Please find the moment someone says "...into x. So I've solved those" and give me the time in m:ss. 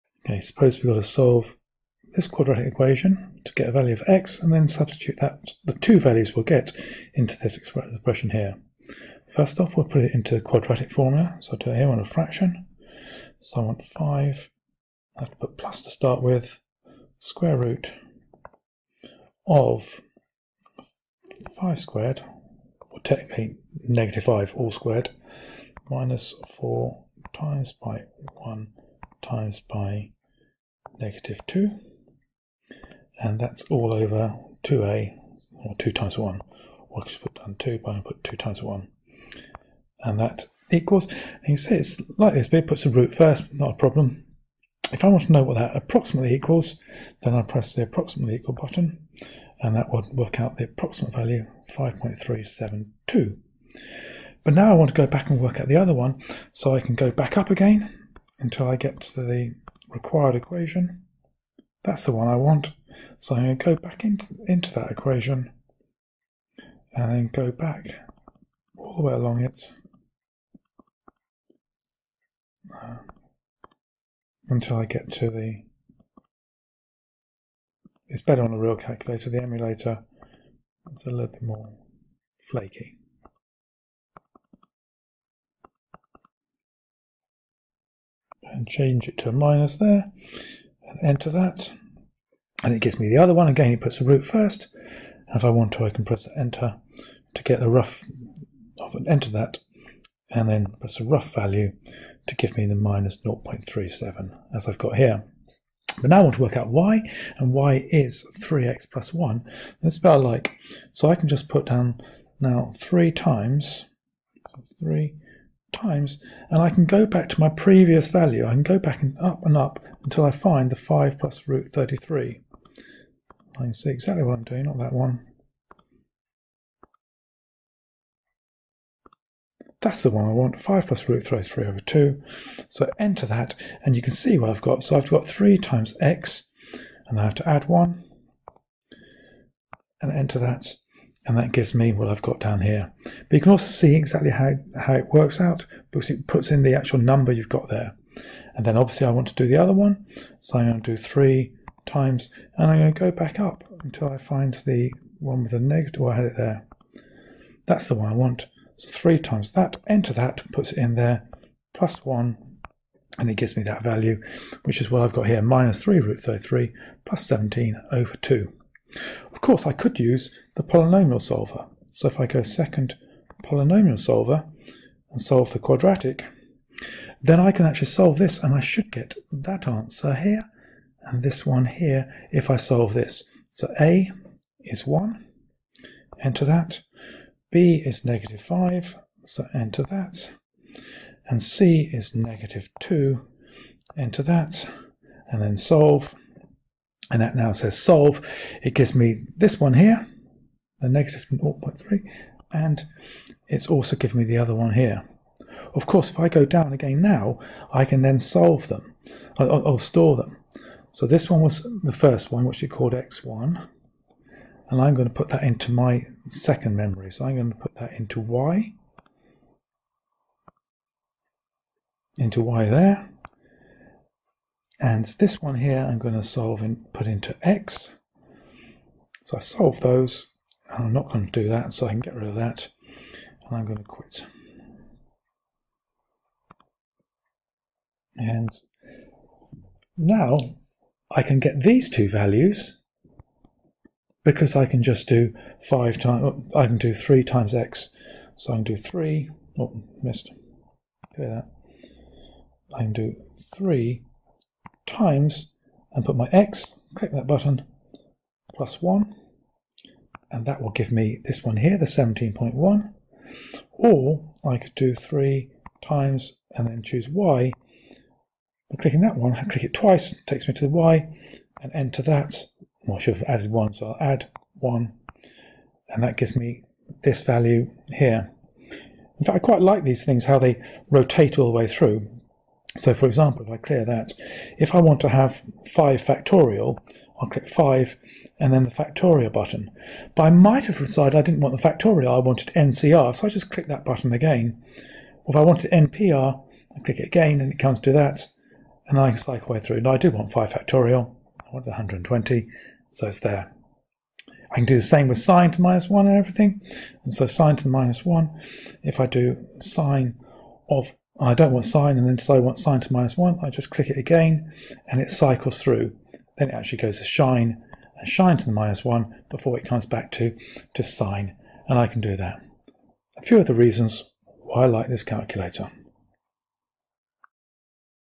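3:47.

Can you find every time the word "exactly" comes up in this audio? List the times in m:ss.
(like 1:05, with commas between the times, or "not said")
2:03, 2:23.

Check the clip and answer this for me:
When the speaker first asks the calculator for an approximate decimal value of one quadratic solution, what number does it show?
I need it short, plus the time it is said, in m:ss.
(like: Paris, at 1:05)
5.372, at 0:51.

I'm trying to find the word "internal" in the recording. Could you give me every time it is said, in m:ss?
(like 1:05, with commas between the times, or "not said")
not said.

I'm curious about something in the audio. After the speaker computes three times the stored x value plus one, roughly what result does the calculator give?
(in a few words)
17.1.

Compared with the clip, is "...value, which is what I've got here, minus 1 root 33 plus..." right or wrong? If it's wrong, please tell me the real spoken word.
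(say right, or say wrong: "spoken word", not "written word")
wrong: "3", not "1".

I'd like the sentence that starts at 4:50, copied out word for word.
But I might have decided I didn't want the factorial, I wanted NCR, so I just click that button again.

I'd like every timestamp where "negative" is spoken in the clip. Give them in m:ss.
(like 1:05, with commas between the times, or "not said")
0:23, 0:30, 2:35, 3:08, 3:12, 3:20.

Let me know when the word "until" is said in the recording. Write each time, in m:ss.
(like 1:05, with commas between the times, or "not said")
0:58, 1:14, 2:00, 2:33.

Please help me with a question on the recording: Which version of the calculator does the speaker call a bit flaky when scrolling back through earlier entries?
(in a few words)
the emulator.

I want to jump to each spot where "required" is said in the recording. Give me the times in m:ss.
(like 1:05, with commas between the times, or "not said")
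0:59.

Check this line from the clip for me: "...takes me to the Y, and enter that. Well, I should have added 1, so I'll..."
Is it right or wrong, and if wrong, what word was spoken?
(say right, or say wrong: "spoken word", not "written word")
right.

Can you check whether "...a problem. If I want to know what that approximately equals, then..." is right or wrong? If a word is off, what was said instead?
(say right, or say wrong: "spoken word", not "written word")
right.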